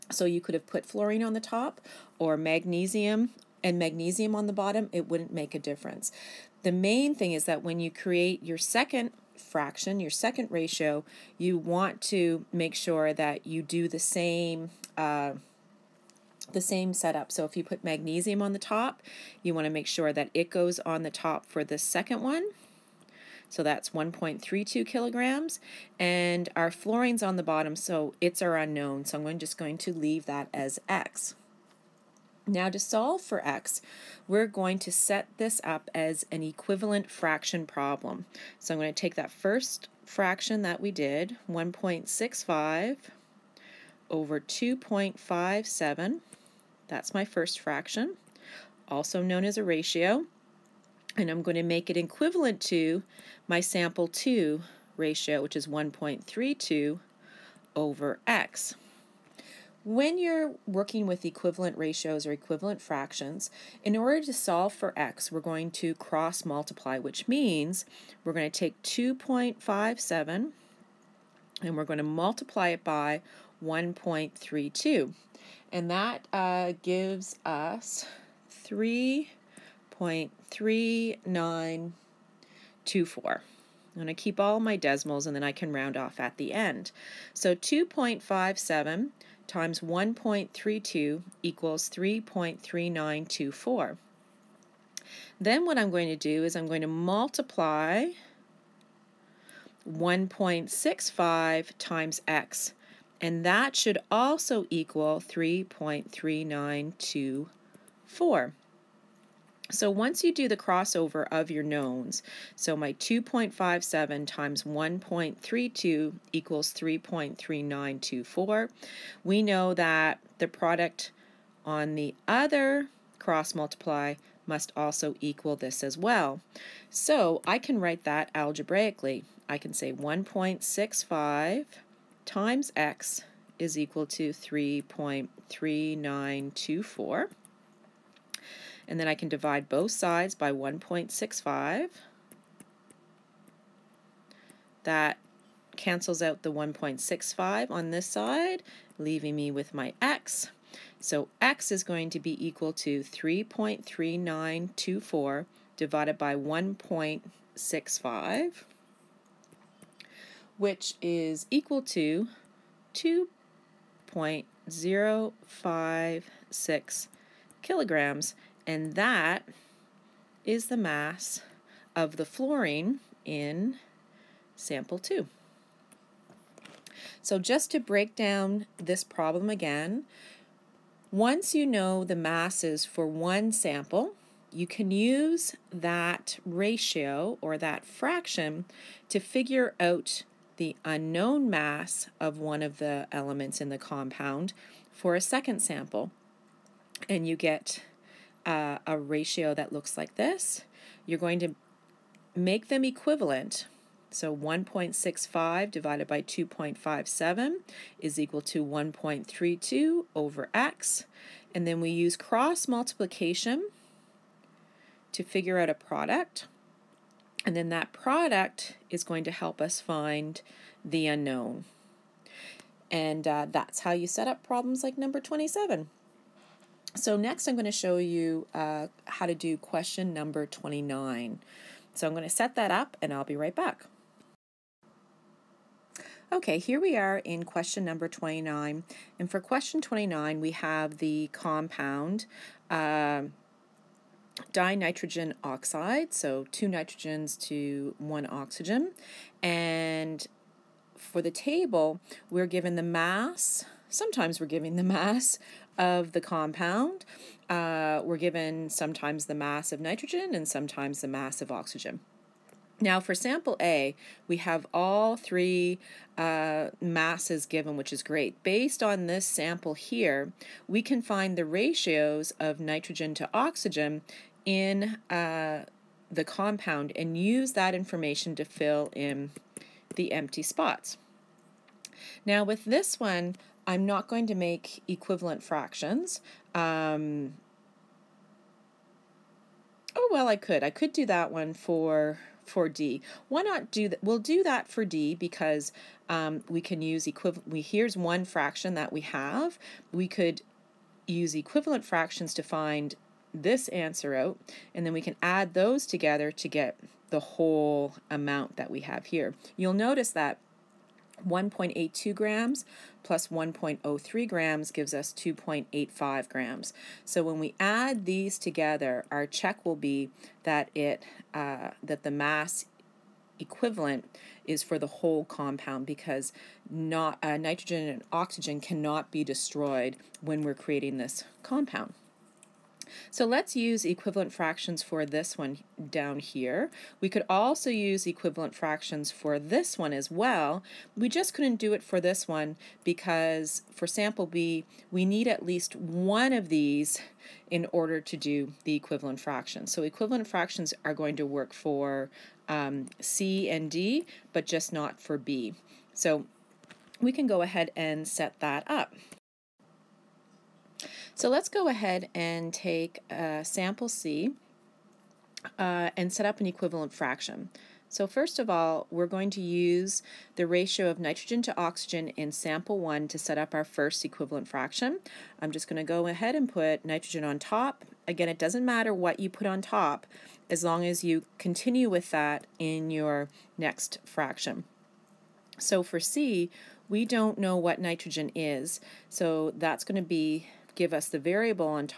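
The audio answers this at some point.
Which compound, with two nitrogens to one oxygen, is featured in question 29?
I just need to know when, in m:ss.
4:04.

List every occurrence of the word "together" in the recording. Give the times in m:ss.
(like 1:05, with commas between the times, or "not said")
5:05, 5:18.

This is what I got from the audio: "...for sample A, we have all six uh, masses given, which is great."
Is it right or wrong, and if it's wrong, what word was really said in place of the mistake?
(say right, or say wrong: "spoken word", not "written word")
wrong: "three", not "six".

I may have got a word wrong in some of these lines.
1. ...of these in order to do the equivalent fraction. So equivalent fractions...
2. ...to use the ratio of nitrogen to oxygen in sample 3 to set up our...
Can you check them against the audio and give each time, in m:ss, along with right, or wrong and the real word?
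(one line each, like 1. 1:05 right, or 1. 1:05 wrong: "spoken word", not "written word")
1. 5:46 right
2. 6:09 wrong: "1", not "3".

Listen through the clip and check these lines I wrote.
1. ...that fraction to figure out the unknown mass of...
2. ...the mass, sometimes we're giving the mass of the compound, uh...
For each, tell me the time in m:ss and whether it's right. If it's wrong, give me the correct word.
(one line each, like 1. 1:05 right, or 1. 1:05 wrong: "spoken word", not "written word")
1. 3:07 right
2. 4:12 right.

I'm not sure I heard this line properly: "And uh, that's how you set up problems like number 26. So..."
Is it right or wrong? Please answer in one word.
wrong.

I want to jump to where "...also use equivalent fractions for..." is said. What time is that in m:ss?
5:37.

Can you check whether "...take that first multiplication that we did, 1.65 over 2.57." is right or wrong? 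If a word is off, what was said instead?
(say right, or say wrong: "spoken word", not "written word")
wrong: "fraction", not "multiplication".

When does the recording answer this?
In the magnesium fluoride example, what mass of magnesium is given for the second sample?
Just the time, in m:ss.
0:23.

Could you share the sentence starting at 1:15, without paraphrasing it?
And that uh, gives us 3.3924.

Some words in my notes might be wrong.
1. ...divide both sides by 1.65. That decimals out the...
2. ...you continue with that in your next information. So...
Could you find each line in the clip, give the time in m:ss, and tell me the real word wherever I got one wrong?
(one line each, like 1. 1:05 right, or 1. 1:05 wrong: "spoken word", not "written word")
1. 2:19 wrong: "cancels", not "decimals"
2. 6:21 wrong: "fraction", not "information".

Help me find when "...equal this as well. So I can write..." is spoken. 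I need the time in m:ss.
2:05.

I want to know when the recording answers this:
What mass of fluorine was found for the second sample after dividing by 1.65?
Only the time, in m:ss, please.
2:42.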